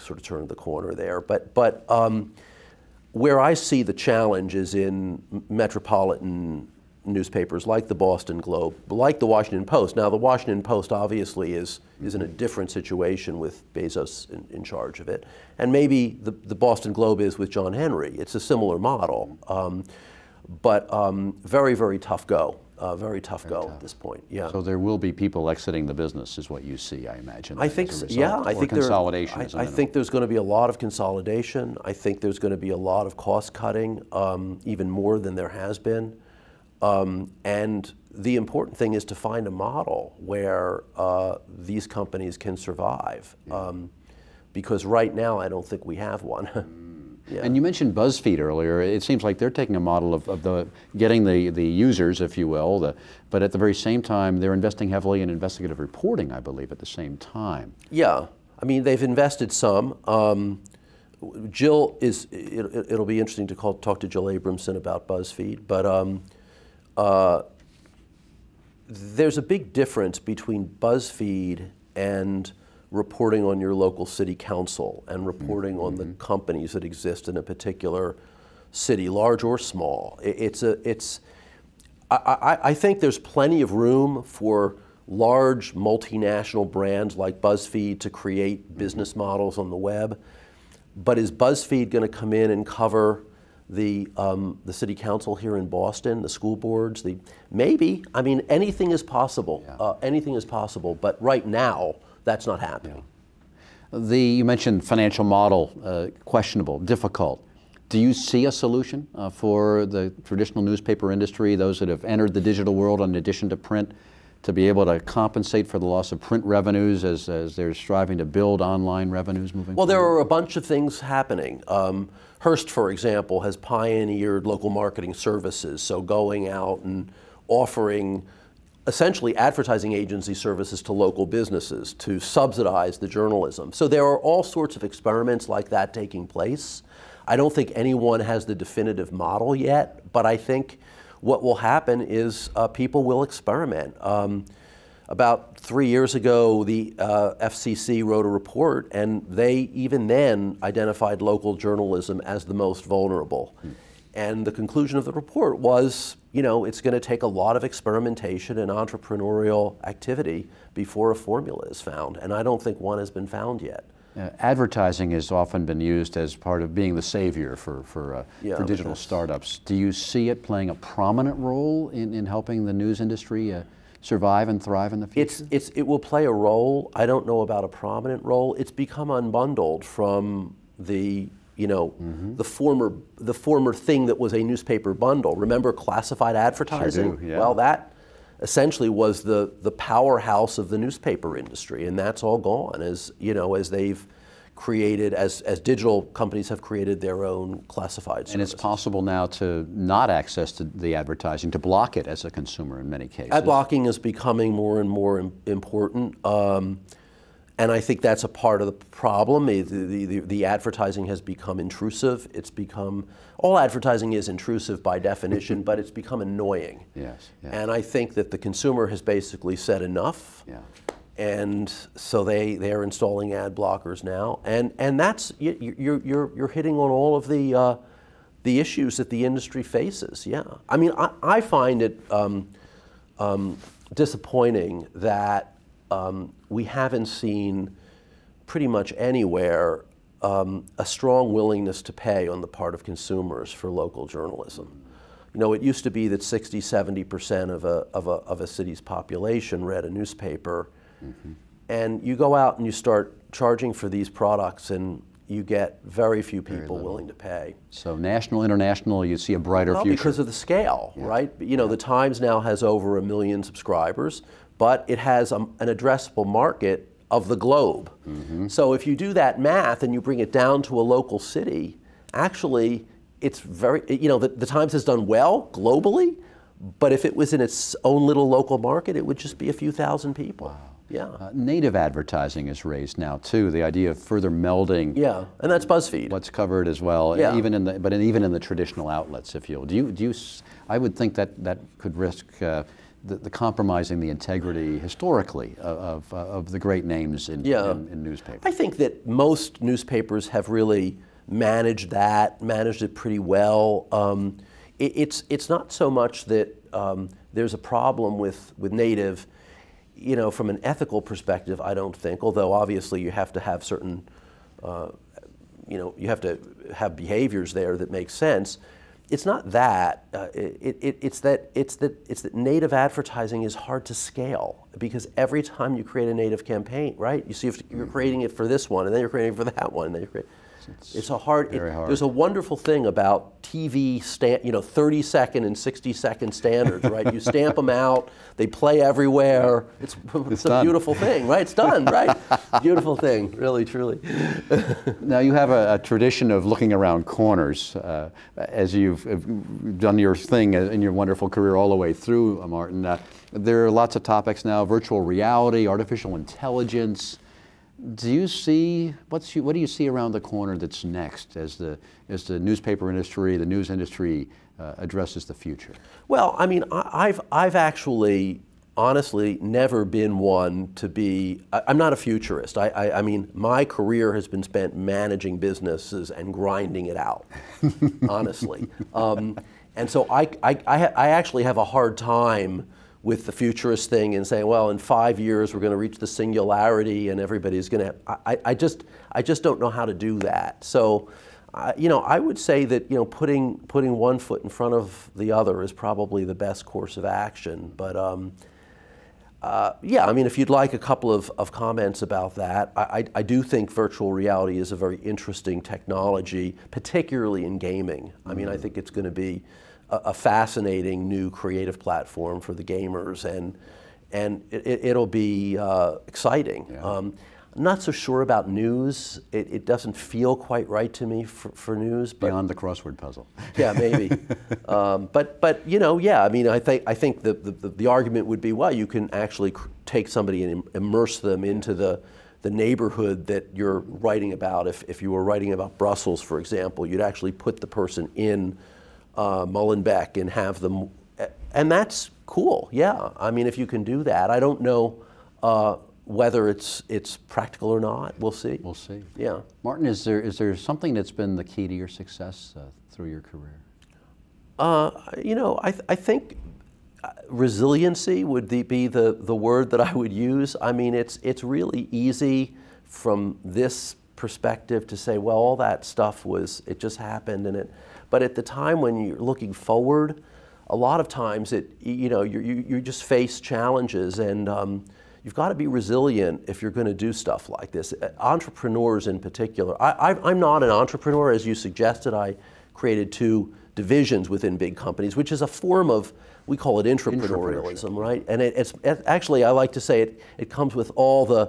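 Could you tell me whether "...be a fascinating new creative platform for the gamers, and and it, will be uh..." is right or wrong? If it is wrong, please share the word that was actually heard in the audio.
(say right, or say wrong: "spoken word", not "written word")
right.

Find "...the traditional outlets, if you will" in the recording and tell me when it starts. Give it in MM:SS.
04:48.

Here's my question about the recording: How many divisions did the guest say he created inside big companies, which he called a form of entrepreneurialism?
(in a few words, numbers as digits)
2.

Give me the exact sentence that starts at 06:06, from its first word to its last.
Well, I mean, I, have I've actually honestly never been one to be.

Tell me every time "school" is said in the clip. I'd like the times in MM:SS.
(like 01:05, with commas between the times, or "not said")
01:36.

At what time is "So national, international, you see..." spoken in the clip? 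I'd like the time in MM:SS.
04:17.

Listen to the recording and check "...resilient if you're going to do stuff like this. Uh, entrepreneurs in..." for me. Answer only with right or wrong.
right.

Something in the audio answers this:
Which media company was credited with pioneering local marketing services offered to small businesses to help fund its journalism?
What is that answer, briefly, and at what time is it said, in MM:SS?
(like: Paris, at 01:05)
Hearst, at 02:02.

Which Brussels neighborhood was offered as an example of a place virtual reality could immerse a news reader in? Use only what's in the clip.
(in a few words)
Molenbeek.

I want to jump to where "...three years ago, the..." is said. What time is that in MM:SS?
02:25.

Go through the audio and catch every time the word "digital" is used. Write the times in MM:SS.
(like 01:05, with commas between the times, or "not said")
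01:52, 02:48, 03:15.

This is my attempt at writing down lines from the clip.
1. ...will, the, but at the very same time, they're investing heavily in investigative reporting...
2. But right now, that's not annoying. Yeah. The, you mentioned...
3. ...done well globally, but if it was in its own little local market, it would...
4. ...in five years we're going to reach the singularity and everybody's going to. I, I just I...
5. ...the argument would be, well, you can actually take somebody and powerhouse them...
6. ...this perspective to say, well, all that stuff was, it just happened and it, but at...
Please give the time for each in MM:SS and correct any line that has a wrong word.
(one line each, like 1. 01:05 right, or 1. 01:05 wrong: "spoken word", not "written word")
1. 00:52 right
2. 01:41 wrong: "happening", not "annoying"
3. 04:34 right
4. 06:24 right
5. 07:07 wrong: "immerse", not "powerhouse"
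6. 07:43 right.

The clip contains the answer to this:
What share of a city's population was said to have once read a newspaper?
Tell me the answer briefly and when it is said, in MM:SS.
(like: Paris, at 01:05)
60 to 70 percent, at 04:06.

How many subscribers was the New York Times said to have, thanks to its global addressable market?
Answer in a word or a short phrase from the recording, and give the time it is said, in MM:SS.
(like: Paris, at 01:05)
Over a million, at 04:22.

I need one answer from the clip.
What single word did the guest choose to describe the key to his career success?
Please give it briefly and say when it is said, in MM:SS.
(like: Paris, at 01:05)
Resiliency, at 07:37.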